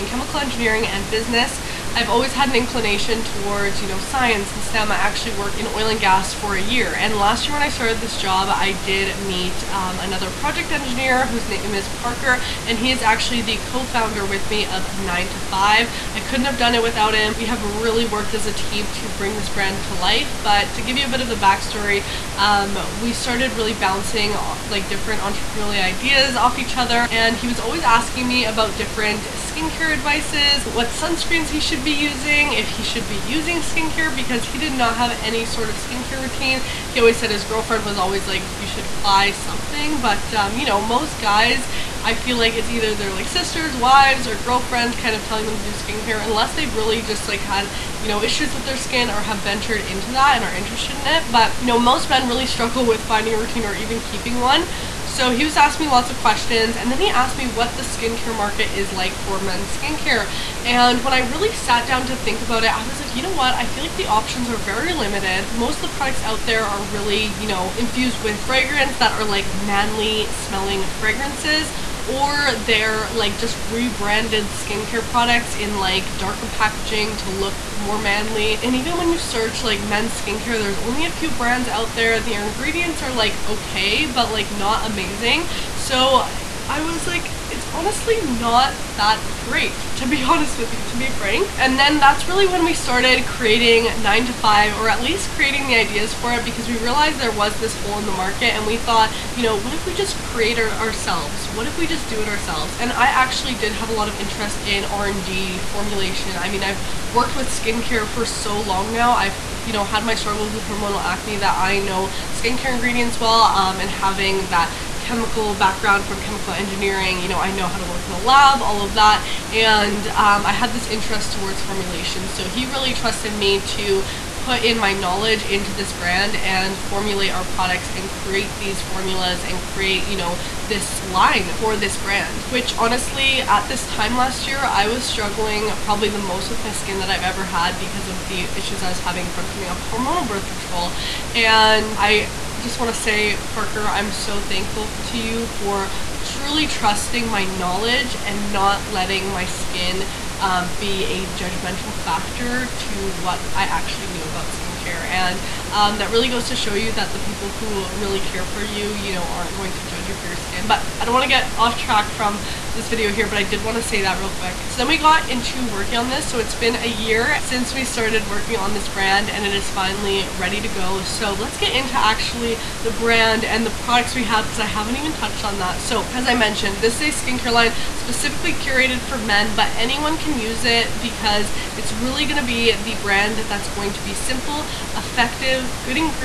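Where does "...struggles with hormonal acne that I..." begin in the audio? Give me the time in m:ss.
1:50.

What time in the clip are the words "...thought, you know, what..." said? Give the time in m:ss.
1:38.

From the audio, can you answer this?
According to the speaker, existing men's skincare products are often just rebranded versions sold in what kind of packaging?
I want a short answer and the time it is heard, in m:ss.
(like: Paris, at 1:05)
Darker packaging, at 1:16.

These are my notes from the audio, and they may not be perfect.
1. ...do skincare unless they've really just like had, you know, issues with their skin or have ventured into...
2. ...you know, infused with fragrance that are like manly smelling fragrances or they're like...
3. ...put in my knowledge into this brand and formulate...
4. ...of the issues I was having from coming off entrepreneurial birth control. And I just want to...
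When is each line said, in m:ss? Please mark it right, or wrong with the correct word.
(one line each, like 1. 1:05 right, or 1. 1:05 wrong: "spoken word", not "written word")
1. 0:45 right
2. 1:07 right
3. 2:04 right
4. 2:18 wrong: "hormonal", not "entrepreneurial".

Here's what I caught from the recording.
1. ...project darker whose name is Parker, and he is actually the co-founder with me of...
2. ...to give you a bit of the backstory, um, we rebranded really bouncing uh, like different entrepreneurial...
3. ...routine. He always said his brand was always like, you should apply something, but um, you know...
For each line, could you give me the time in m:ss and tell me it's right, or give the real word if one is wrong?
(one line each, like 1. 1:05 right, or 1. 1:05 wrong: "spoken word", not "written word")
1. 0:10 wrong: "engineer", not "darker"
2. 0:20 wrong: "started", not "rebranded"
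3. 0:36 wrong: "girlfriend", not "brand".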